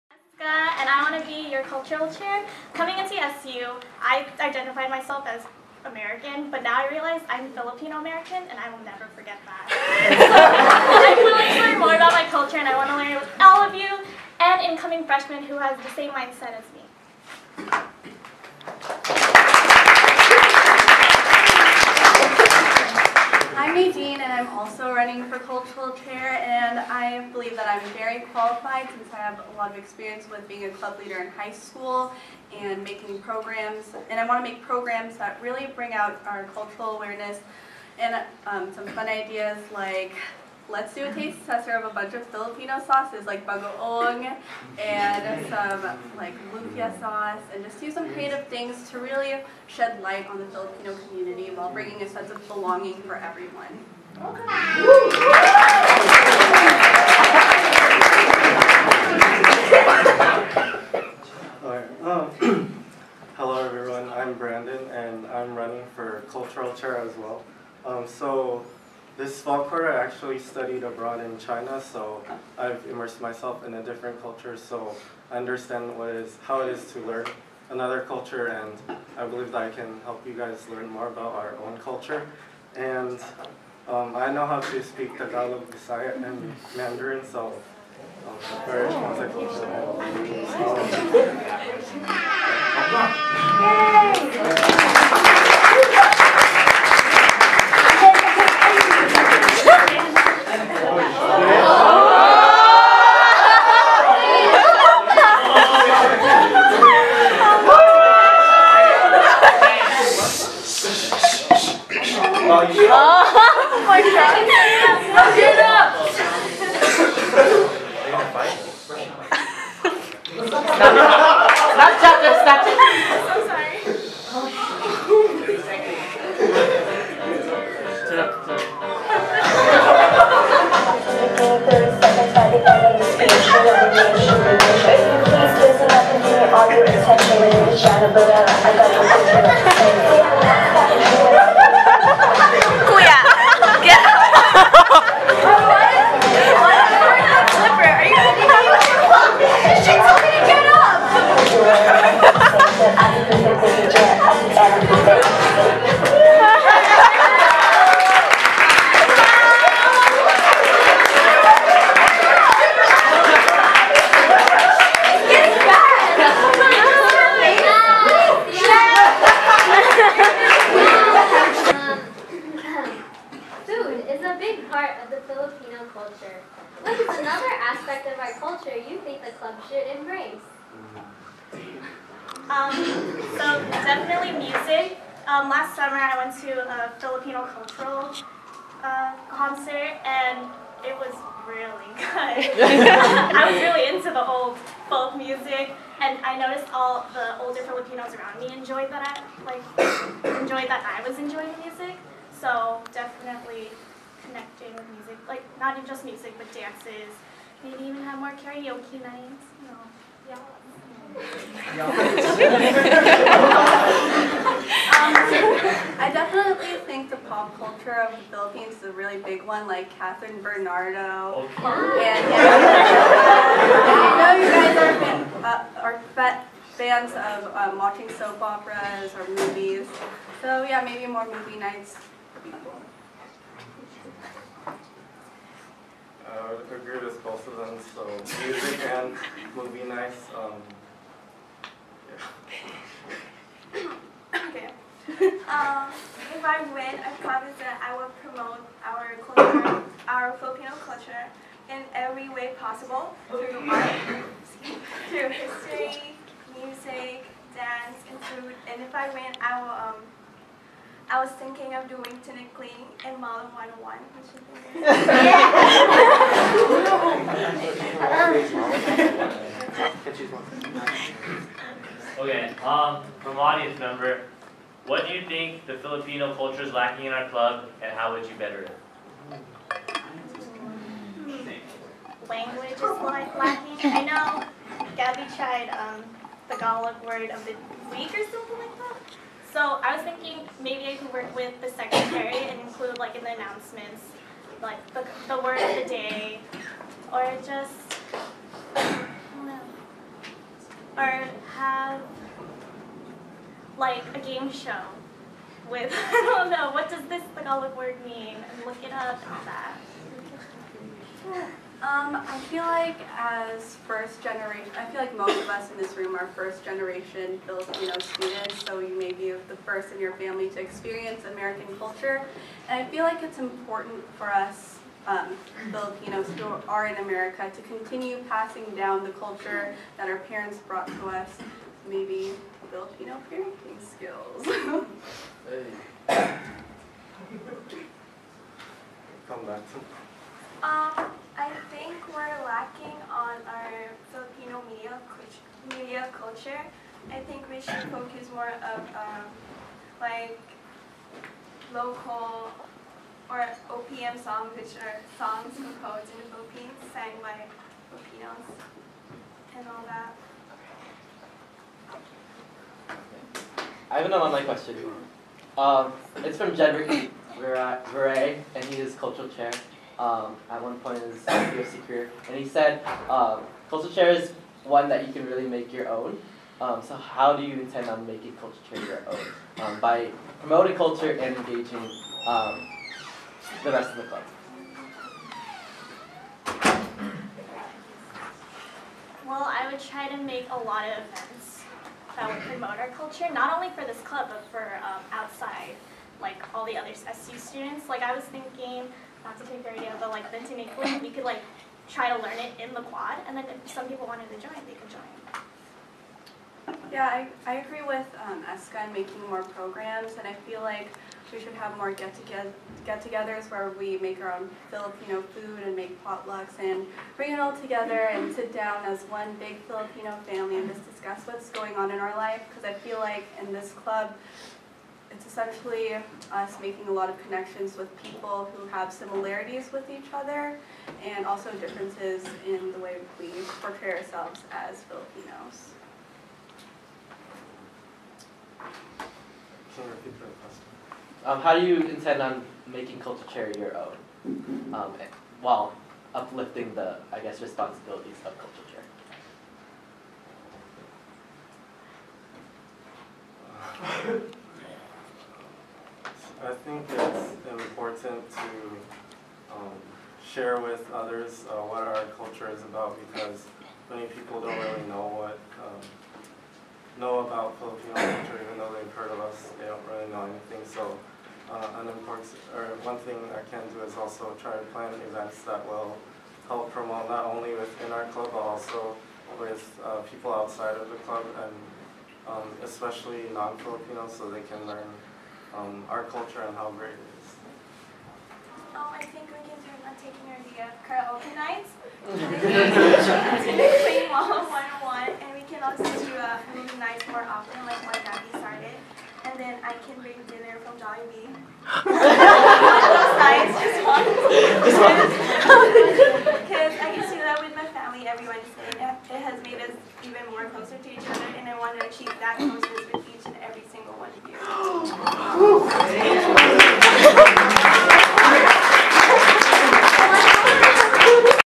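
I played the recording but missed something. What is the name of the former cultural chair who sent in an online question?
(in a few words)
Jedrick Veray.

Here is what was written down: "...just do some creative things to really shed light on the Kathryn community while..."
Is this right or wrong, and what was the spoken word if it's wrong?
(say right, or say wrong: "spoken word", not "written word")
wrong: "Filipino", not "Kathryn".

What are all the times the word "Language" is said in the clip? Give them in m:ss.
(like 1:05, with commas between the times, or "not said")
4:42.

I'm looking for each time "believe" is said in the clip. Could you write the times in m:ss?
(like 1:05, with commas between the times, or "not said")
0:27, 1:19, 6:40.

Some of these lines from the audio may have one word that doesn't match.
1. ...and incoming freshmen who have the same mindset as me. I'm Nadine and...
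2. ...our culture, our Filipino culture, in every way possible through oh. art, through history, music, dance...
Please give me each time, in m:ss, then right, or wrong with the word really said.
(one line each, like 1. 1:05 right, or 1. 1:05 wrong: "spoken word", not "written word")
1. 0:14 right
2. 4:08 right.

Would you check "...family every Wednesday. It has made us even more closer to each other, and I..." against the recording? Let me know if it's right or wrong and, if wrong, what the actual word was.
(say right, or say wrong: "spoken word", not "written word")
right.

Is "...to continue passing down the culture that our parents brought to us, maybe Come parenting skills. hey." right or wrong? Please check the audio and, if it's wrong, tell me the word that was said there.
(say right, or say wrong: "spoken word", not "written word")
wrong: "Filipino", not "Come".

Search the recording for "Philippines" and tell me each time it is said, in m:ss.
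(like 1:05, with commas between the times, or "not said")
3:38, 5:56.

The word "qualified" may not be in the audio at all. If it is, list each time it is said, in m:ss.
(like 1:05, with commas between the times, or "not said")
0:28.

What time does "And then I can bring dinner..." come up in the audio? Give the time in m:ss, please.
8:19.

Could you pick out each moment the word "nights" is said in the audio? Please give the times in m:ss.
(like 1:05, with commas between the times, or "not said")
3:29, 3:51, 3:59, 8:11, 8:16, 8:23.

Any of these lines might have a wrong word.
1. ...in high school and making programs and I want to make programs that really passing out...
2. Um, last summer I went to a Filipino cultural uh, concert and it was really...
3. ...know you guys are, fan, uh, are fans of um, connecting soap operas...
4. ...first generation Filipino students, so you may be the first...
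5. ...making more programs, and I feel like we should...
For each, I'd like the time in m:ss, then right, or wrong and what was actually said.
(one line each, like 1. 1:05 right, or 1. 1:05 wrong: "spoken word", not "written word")
1. 0:31 wrong: "bring", not "passing"
2. 3:05 right
3. 3:44 wrong: "watching", not "connecting"
4. 5:16 right
5. 6:48 right.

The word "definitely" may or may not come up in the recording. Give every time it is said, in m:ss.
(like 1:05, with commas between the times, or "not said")
3:03, 3:22, 3:36.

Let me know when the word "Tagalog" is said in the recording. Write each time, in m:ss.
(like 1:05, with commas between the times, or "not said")
1:25, 4:46, 5:07.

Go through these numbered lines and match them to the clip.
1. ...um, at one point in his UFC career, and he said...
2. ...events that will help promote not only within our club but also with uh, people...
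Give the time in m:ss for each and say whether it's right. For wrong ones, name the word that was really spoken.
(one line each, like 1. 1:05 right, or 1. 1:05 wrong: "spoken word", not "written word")
1. 6:10 right
2. 7:55 right.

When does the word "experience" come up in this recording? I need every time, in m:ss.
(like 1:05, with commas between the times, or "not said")
0:29, 5:20.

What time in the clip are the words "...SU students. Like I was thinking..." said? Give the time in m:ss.
6:37.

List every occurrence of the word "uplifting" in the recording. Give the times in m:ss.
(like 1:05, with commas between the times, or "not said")
7:26.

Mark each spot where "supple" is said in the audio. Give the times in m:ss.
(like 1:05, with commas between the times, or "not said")
not said.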